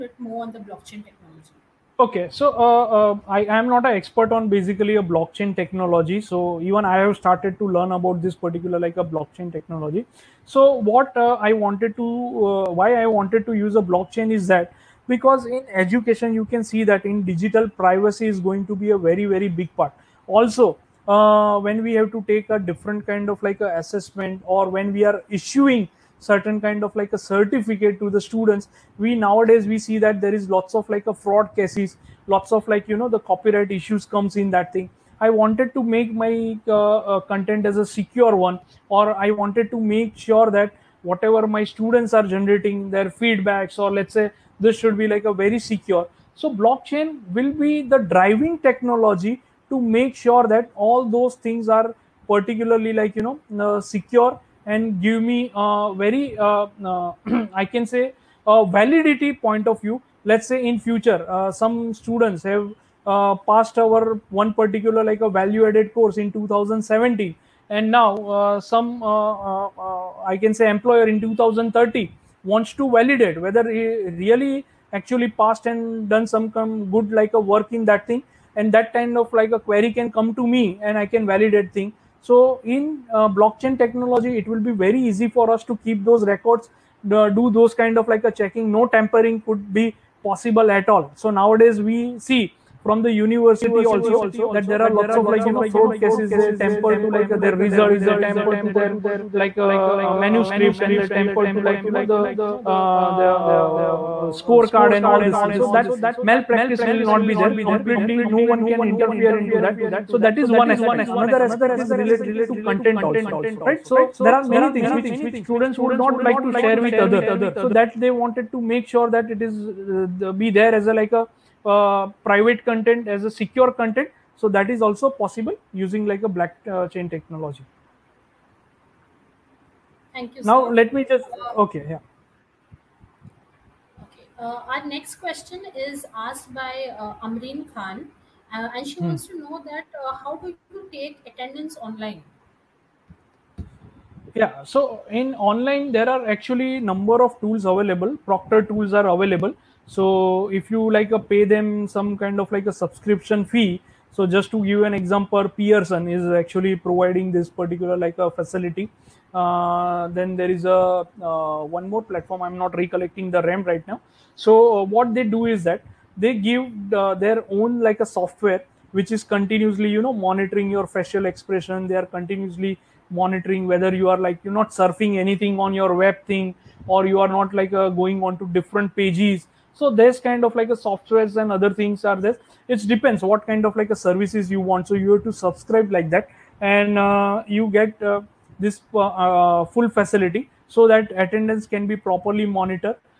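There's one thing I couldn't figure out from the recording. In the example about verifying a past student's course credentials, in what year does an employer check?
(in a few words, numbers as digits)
2030.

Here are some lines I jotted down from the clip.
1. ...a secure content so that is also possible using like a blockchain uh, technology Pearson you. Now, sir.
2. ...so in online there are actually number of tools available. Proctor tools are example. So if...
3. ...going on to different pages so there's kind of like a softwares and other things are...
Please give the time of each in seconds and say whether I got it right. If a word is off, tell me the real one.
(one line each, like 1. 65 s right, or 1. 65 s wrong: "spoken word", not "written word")
1. 123 s wrong: "Thank", not "Pearson"
2. 144 s wrong: "available", not "example"
3. 177 s right.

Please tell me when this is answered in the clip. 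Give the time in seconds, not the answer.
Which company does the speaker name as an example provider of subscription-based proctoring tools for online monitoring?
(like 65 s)
155 s.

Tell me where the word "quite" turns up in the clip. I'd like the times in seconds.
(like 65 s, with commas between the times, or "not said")
not said.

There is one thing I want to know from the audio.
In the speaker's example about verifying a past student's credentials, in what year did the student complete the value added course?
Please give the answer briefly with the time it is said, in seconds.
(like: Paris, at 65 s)
2017, at 66 s.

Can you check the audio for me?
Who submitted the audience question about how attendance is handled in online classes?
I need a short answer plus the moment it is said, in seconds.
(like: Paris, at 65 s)
Amreen Khan, at 137 s.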